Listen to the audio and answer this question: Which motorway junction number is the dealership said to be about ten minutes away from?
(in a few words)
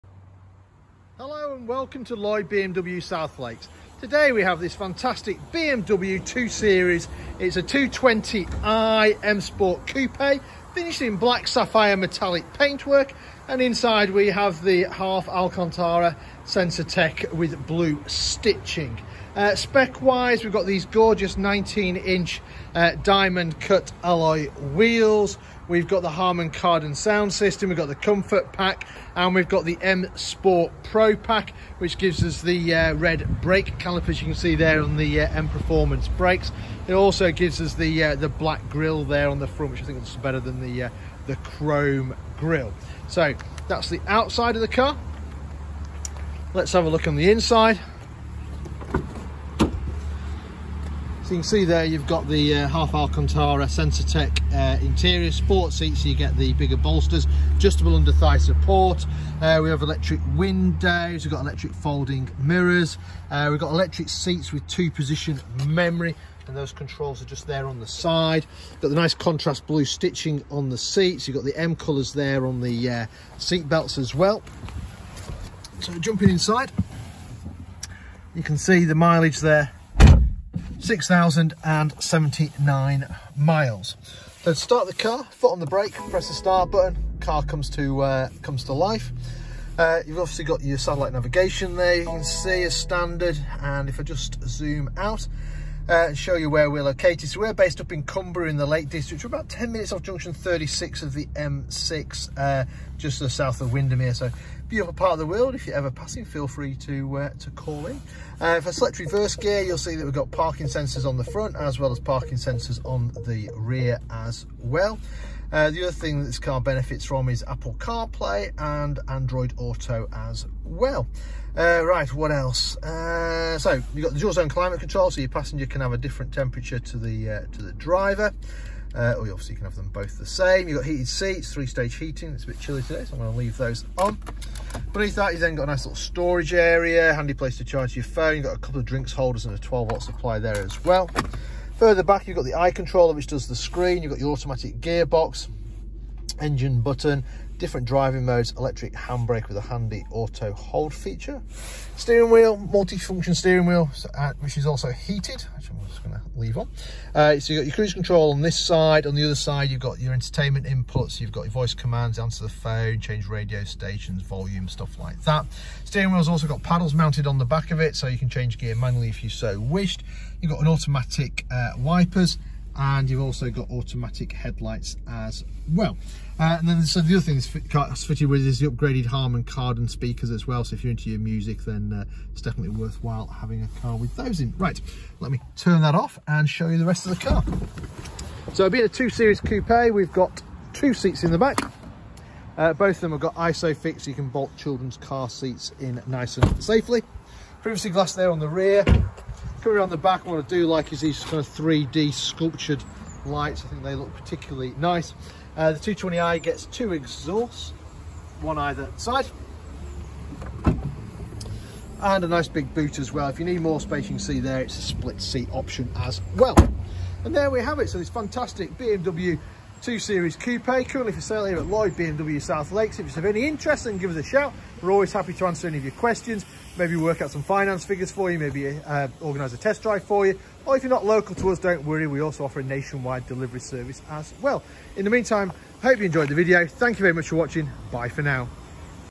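36.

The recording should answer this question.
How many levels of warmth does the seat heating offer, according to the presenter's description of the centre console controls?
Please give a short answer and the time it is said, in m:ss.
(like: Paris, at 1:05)
3, at 2:11.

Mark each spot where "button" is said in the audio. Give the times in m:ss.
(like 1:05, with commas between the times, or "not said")
1:26, 2:26.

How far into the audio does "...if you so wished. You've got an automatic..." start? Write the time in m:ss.
2:49.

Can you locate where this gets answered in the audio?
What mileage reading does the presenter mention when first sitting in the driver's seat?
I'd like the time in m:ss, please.
1:20.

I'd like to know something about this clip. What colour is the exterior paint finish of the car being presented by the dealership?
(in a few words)
Black sapphire metallic.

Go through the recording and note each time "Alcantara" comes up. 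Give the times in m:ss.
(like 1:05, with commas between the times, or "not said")
0:15, 0:52.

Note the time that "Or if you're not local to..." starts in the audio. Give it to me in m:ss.
3:50.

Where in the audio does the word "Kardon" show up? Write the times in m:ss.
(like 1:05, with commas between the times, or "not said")
0:26, 2:59.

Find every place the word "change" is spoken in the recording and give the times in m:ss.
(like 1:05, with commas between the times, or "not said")
2:42, 2:48.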